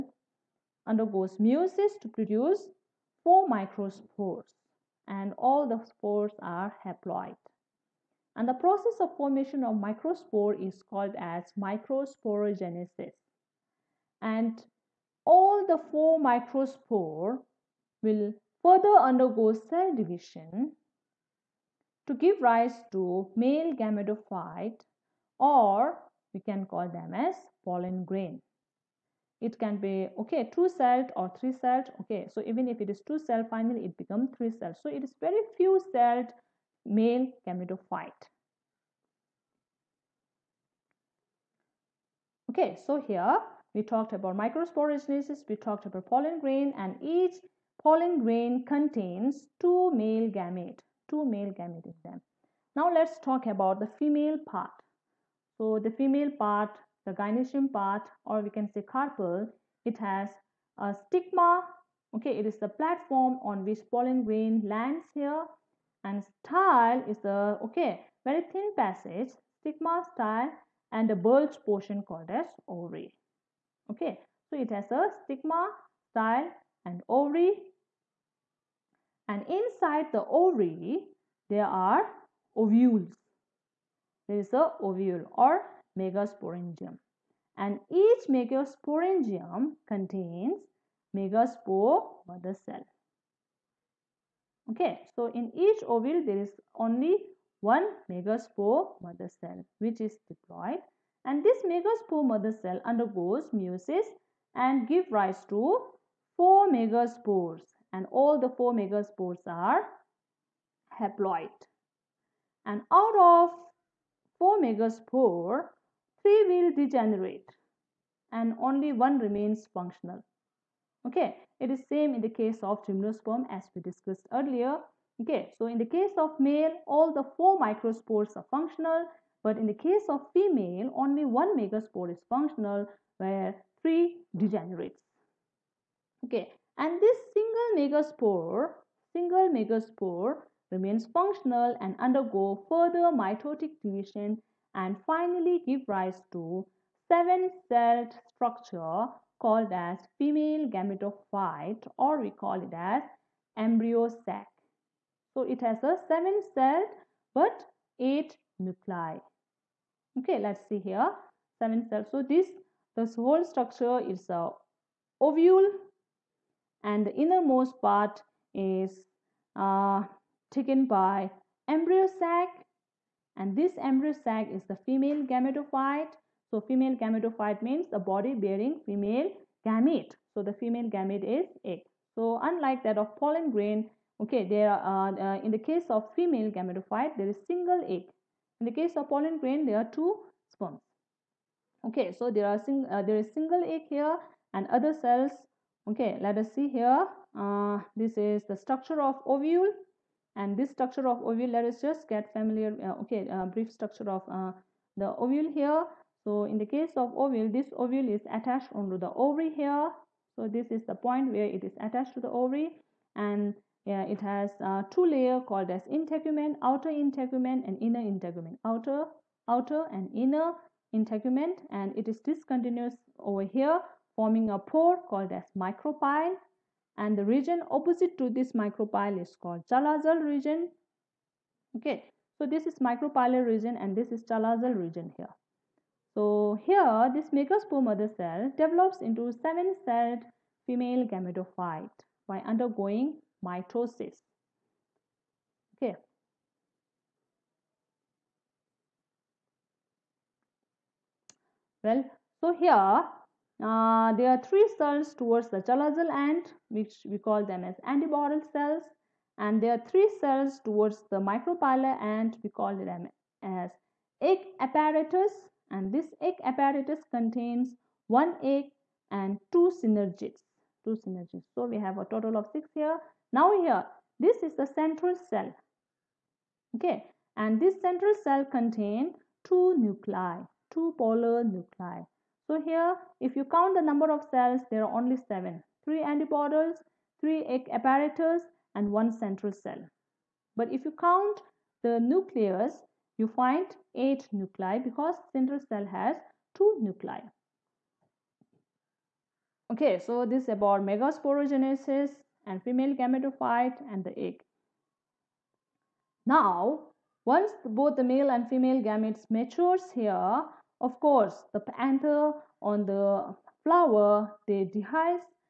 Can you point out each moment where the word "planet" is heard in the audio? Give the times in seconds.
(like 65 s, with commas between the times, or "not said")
not said.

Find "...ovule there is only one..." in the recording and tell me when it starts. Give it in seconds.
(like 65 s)
95 s.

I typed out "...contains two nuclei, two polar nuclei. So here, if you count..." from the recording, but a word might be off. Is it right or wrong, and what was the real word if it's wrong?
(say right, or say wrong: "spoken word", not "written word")
right.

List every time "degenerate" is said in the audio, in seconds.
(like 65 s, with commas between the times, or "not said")
116 s, 134 s.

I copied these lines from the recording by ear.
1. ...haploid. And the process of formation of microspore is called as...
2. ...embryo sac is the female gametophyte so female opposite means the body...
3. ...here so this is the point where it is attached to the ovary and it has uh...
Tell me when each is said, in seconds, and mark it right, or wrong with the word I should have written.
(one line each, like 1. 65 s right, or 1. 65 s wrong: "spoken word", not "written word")
1. 6 s right
2. 173 s wrong: "gametophyte", not "opposite"
3. 209 s right.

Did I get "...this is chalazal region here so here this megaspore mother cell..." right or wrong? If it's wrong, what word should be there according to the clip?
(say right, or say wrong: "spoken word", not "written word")
right.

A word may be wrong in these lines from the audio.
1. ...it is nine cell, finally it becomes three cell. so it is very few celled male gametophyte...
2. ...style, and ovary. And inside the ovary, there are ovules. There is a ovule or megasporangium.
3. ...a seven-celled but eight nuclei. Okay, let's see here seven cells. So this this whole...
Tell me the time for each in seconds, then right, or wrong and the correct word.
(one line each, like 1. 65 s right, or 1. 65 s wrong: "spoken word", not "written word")
1. 32 s wrong: "two", not "nine"
2. 76 s right
3. 155 s right.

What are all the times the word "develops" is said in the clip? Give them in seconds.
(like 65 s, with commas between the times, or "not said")
238 s.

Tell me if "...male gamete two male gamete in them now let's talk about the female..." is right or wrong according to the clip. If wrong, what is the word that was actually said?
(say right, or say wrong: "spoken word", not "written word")
right.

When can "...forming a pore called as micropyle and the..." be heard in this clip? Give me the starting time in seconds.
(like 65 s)
224 s.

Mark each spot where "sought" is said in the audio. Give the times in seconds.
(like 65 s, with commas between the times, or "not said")
not said.